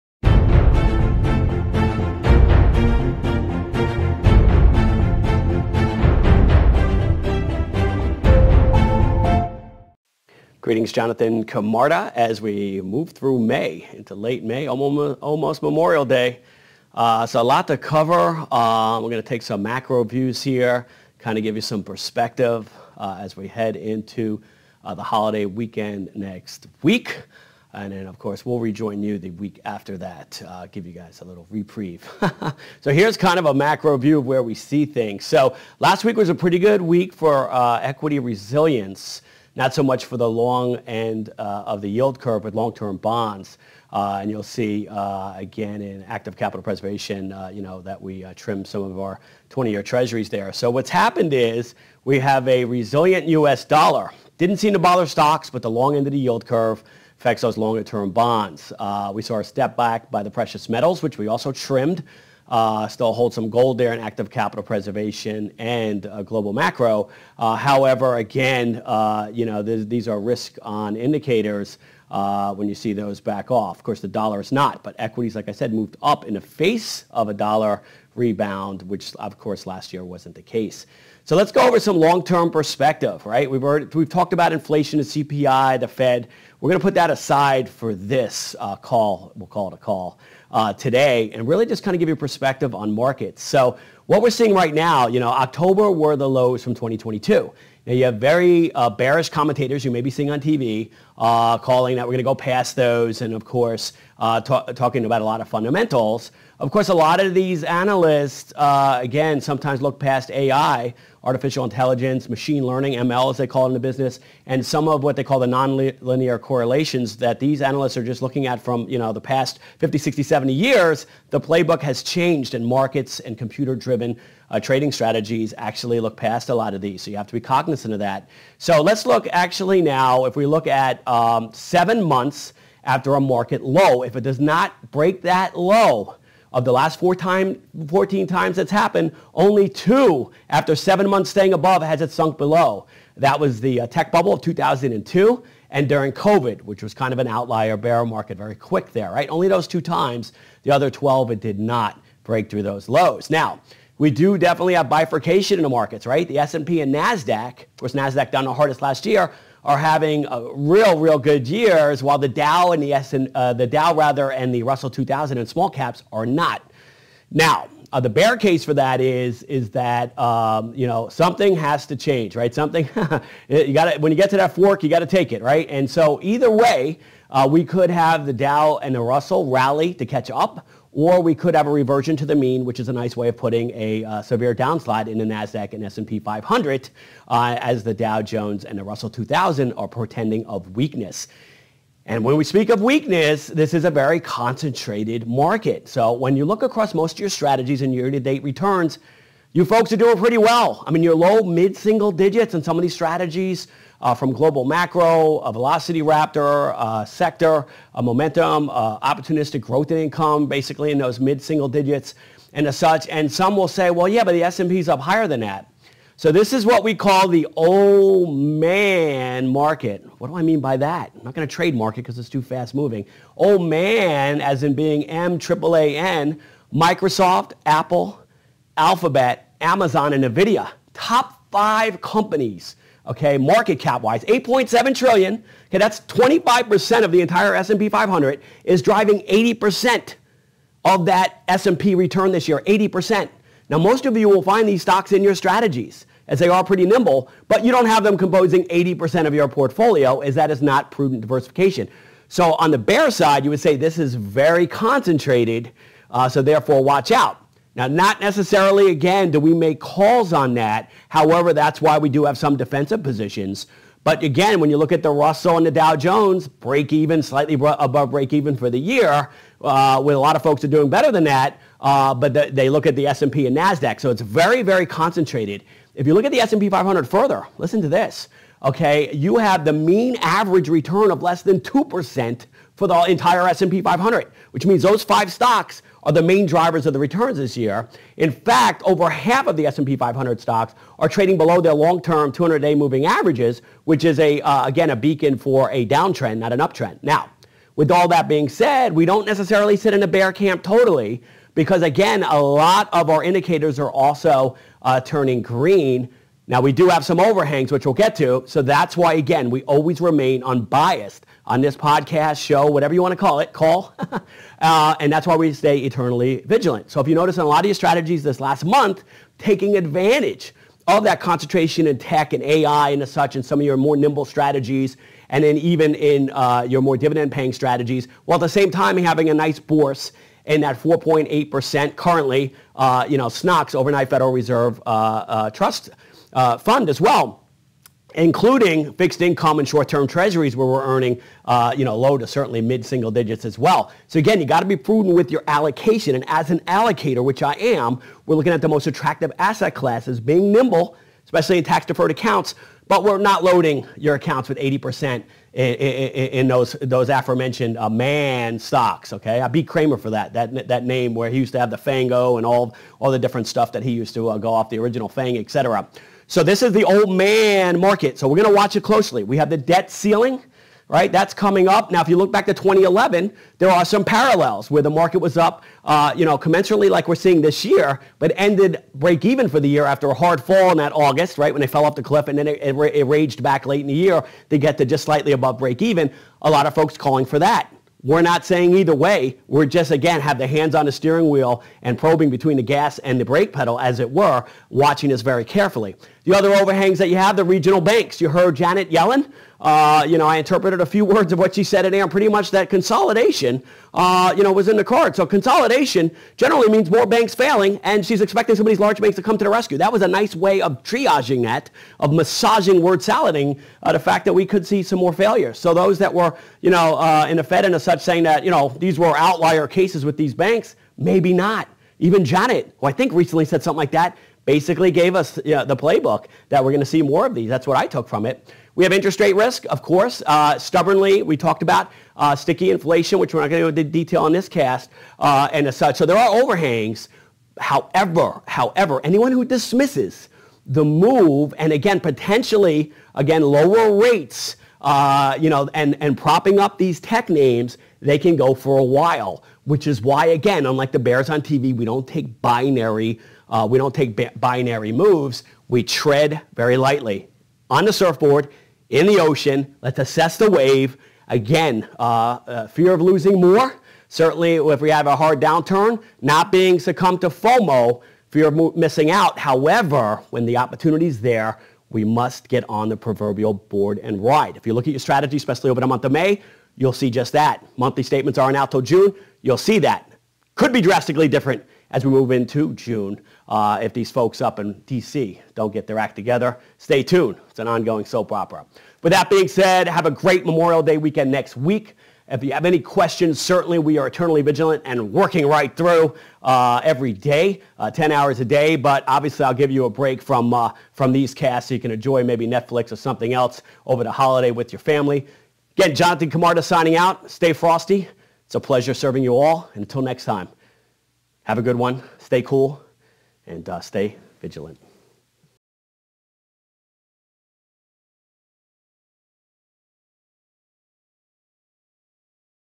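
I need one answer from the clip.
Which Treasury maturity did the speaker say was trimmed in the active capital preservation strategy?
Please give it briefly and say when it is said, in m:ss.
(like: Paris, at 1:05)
20-year, at 0:49.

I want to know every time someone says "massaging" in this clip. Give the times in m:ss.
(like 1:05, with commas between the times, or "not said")
6:52.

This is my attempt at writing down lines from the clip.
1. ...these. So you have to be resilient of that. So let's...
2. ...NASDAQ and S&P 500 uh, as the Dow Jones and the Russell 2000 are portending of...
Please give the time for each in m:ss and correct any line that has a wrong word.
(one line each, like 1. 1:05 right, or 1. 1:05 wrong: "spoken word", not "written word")
1. 2:06 wrong: "cognizant", not "resilient"
2. 3:05 right.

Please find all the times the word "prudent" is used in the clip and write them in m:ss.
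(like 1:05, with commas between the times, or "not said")
4:10, 5:44.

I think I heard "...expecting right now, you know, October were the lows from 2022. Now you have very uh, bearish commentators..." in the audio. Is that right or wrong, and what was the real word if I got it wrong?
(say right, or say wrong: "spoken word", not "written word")
wrong: "seeing", not "expecting".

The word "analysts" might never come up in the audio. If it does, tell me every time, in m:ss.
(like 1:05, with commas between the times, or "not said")
1:47, 1:57.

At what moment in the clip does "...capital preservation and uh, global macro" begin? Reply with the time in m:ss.
1:04.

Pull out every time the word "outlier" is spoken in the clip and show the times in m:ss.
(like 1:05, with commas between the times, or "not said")
2:27, 6:59.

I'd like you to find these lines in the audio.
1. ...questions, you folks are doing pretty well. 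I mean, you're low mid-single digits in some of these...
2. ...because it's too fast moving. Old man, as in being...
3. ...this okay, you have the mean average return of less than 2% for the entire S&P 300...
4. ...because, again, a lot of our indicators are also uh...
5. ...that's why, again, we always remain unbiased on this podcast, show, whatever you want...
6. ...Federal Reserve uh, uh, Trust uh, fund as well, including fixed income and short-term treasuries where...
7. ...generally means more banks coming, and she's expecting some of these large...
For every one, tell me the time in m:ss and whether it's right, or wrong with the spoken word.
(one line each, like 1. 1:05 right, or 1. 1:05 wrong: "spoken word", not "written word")
1. 3:18 wrong: "returns", not "questions"
2. 3:42 right
3. 4:37 wrong: "500", not "300"
4. 5:01 right
5. 5:08 right
6. 5:34 right
7. 6:46 wrong: "failing", not "coming".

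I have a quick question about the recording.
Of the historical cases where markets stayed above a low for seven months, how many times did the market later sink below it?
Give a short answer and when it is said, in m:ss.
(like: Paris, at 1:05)
2, at 2:19.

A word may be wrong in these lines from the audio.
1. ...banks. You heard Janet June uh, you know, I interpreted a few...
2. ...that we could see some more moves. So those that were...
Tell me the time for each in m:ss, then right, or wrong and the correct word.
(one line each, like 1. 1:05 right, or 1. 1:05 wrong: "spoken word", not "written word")
1. 6:37 wrong: "Yellen", not "June"
2. 6:54 wrong: "failures", not "moves".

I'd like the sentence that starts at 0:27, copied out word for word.
And then, of course, we'll rejoin you the week after that, uh, give you guys a little reprieve.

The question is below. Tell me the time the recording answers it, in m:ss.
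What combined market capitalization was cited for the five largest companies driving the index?
3:54.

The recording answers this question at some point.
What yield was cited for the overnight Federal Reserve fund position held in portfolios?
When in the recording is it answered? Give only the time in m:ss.
5:30.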